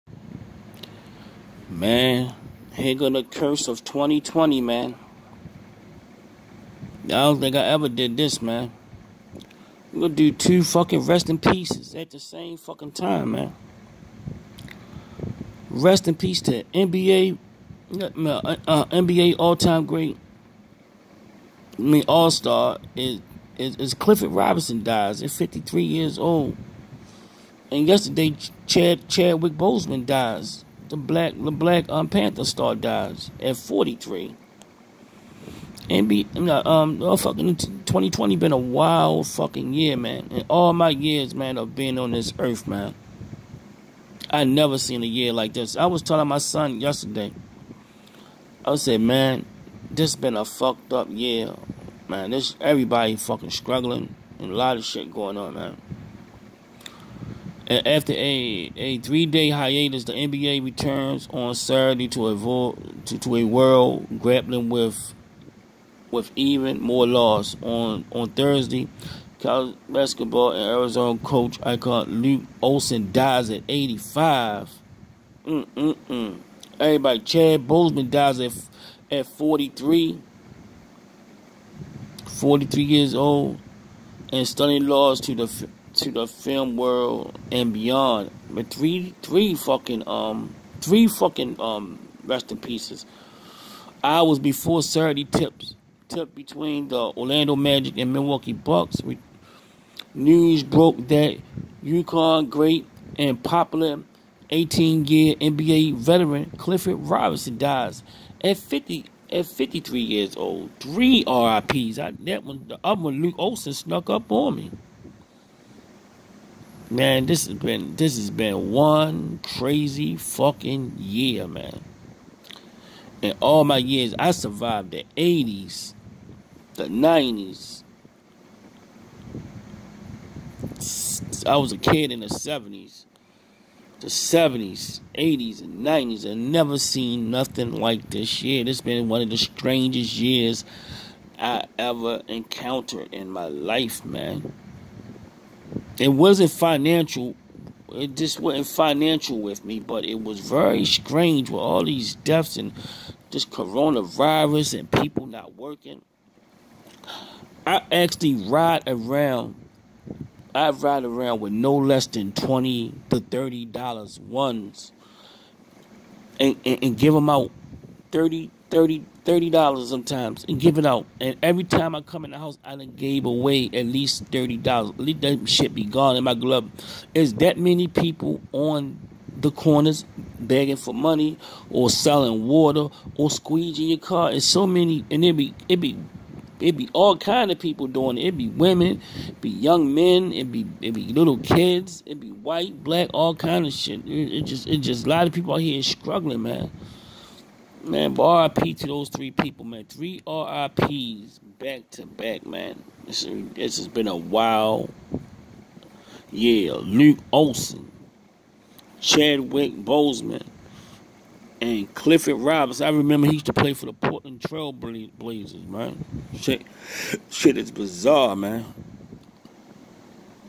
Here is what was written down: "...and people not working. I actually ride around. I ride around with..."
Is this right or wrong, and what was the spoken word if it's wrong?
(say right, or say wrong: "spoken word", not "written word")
right.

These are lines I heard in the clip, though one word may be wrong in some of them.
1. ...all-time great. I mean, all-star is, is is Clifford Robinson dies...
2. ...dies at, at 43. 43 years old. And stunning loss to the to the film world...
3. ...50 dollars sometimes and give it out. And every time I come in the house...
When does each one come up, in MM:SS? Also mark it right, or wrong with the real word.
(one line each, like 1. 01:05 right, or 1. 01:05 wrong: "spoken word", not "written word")
1. 00:19 right
2. 01:18 right
3. 02:48 wrong: "30", not "50".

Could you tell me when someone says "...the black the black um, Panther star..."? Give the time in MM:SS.
00:30.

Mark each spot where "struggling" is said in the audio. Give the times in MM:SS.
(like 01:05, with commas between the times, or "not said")
00:53, 03:15.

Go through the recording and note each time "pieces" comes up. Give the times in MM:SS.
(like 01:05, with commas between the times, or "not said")
00:11, 01:32.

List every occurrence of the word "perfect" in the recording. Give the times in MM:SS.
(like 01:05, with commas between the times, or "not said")
not said.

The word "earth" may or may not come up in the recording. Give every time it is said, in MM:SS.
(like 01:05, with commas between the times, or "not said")
00:42.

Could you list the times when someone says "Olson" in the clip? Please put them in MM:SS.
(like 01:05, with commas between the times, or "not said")
01:12, 01:53, 03:27.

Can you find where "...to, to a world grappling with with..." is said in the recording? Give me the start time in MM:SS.
01:03.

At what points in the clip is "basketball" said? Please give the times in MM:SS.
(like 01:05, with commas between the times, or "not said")
01:09.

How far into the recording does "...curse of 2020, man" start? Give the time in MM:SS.
00:03.